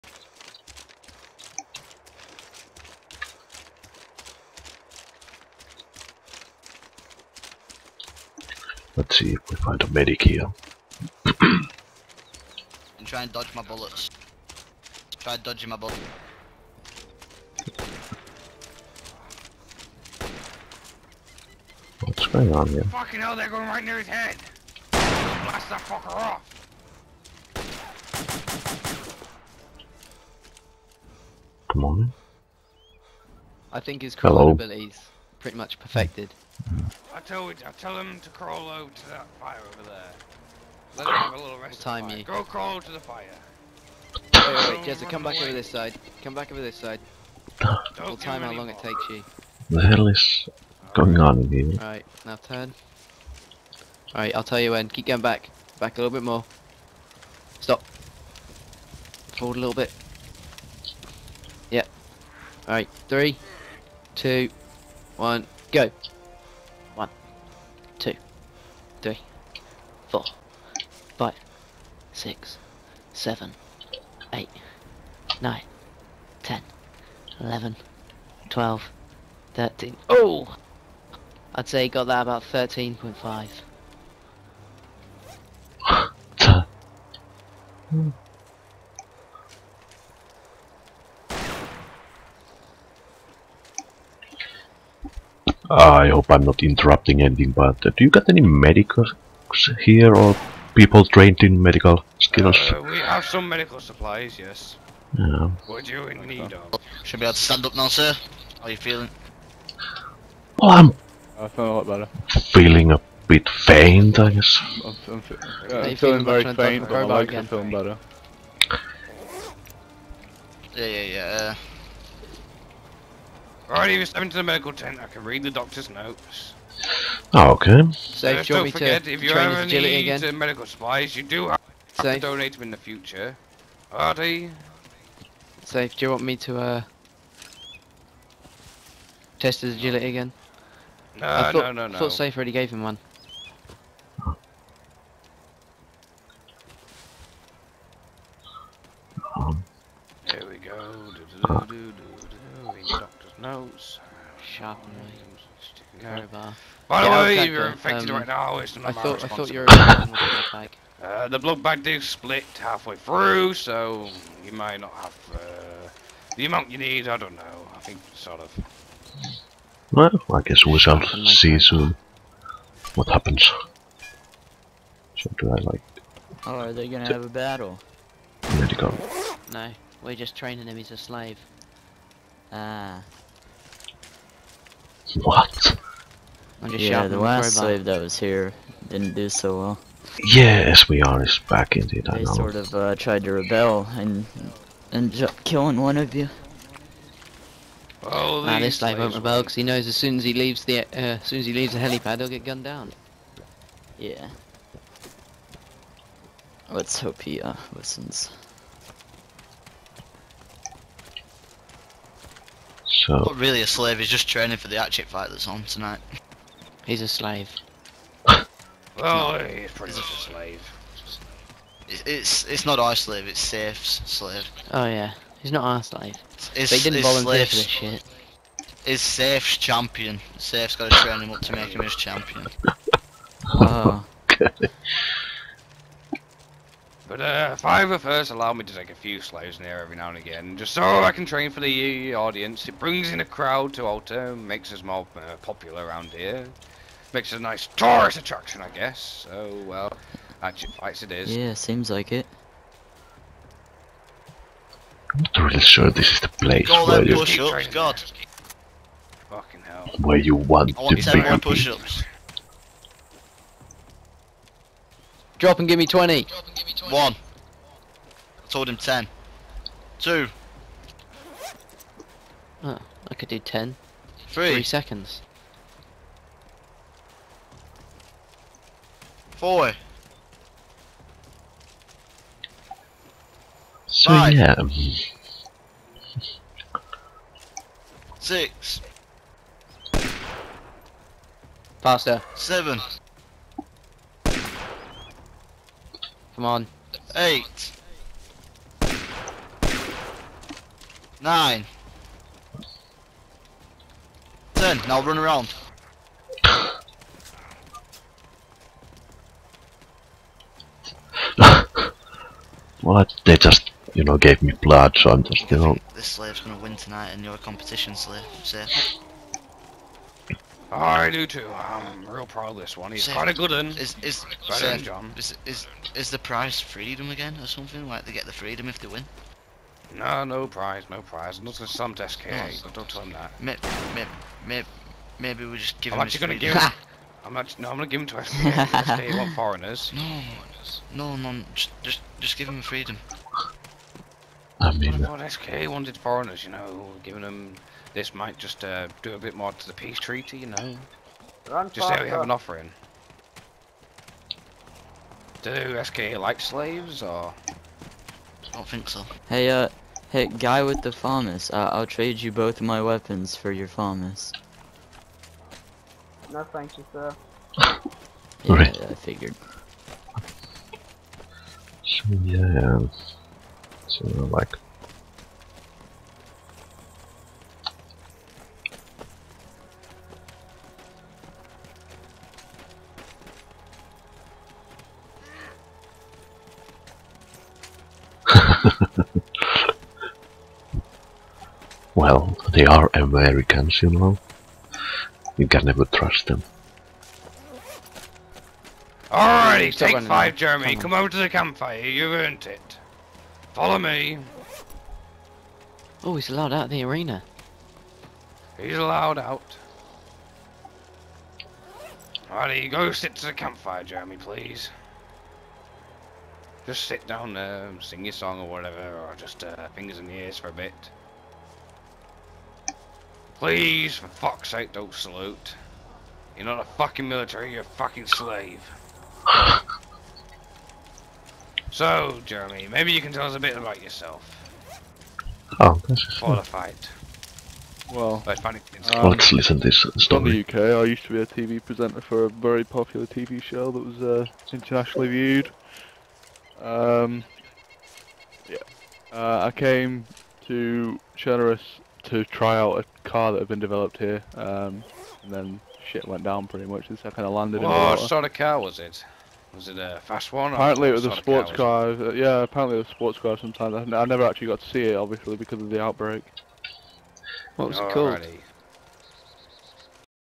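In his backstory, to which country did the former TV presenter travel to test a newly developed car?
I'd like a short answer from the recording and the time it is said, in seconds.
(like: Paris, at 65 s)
Chernarus, at 451 s.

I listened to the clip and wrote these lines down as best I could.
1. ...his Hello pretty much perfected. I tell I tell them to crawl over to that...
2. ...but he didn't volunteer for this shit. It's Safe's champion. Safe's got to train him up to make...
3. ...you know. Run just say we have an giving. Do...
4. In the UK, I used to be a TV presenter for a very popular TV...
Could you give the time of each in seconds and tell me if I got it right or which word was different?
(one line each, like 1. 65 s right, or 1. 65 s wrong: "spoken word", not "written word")
1. 34 s right
2. 226 s right
3. 350 s wrong: "offering", not "giving"
4. 440 s right.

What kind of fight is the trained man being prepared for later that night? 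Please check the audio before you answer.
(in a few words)
hatchet fight.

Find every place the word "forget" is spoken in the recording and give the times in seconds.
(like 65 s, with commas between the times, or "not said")
128 s.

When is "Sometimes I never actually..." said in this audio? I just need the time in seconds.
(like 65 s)
463 s.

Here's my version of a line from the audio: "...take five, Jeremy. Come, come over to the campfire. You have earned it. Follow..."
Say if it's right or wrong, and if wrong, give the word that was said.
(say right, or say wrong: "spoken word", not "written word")
right.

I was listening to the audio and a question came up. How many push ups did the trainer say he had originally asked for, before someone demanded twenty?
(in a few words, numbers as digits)
10.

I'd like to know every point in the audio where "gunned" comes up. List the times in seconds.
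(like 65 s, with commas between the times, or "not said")
202 s.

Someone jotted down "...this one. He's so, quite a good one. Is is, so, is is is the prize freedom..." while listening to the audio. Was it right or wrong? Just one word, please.
right.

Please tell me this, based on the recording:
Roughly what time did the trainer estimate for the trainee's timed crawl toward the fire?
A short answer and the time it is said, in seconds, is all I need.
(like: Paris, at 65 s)
13.5, at 82 s.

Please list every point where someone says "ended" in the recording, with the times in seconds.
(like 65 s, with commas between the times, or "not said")
194 s.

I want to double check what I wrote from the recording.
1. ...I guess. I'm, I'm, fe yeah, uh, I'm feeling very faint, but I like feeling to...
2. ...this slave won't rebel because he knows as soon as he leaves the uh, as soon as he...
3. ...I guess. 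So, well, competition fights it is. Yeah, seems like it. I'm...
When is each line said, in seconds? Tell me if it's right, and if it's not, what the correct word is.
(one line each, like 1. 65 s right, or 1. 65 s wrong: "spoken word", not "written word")
1. 114 s right
2. 198 s right
3. 248 s wrong: "action", not "competition".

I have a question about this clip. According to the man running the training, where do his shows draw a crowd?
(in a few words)
Altar.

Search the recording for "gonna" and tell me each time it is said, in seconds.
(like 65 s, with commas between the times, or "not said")
176 s, 316 s.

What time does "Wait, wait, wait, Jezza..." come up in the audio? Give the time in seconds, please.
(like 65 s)
44 s.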